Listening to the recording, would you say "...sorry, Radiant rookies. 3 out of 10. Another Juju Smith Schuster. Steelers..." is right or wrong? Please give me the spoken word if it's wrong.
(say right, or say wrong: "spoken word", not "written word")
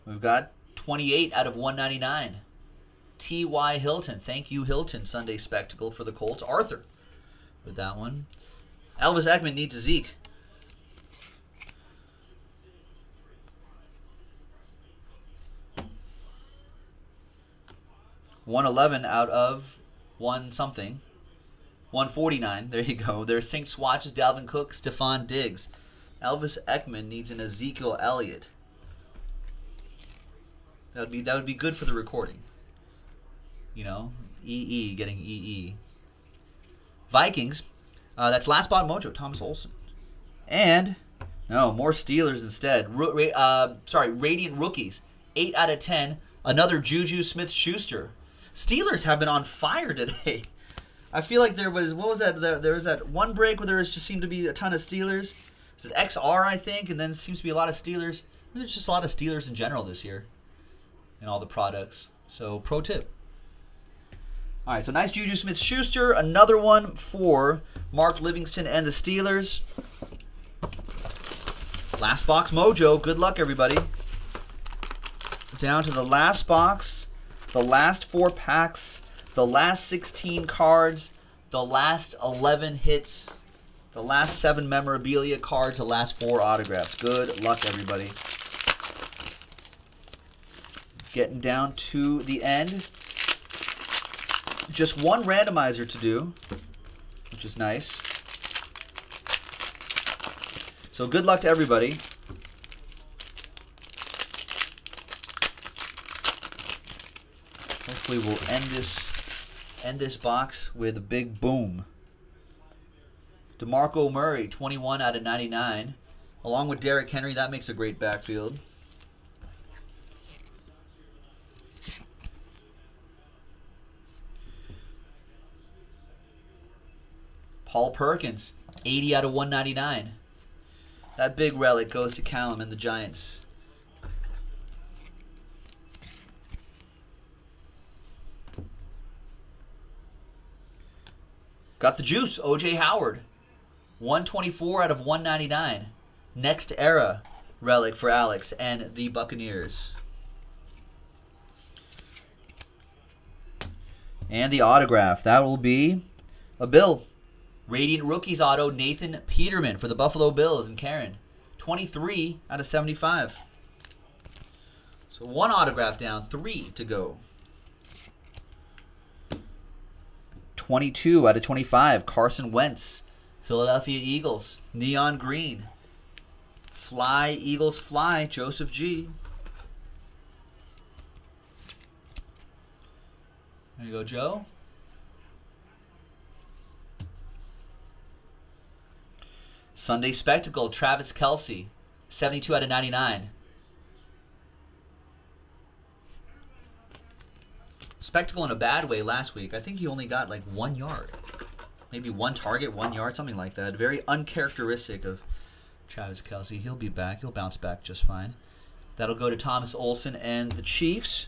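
wrong: "8", not "3".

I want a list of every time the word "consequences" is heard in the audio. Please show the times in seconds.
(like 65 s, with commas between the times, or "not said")
not said.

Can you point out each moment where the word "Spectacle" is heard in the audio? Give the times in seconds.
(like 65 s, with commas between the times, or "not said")
5 s, 190 s, 198 s.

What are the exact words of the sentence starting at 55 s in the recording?
It's an XR, I think, and then seems to be a lot of Steelers.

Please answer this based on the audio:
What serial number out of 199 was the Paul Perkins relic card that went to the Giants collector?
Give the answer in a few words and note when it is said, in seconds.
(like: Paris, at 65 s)
80, at 128 s.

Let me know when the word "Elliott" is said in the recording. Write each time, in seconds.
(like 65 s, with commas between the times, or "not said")
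27 s.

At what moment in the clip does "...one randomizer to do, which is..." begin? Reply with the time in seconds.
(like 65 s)
95 s.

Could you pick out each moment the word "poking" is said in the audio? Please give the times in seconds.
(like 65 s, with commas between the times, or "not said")
not said.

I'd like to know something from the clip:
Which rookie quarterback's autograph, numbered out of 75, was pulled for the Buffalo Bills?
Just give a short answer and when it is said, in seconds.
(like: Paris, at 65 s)
Nathan Peterman, at 158 s.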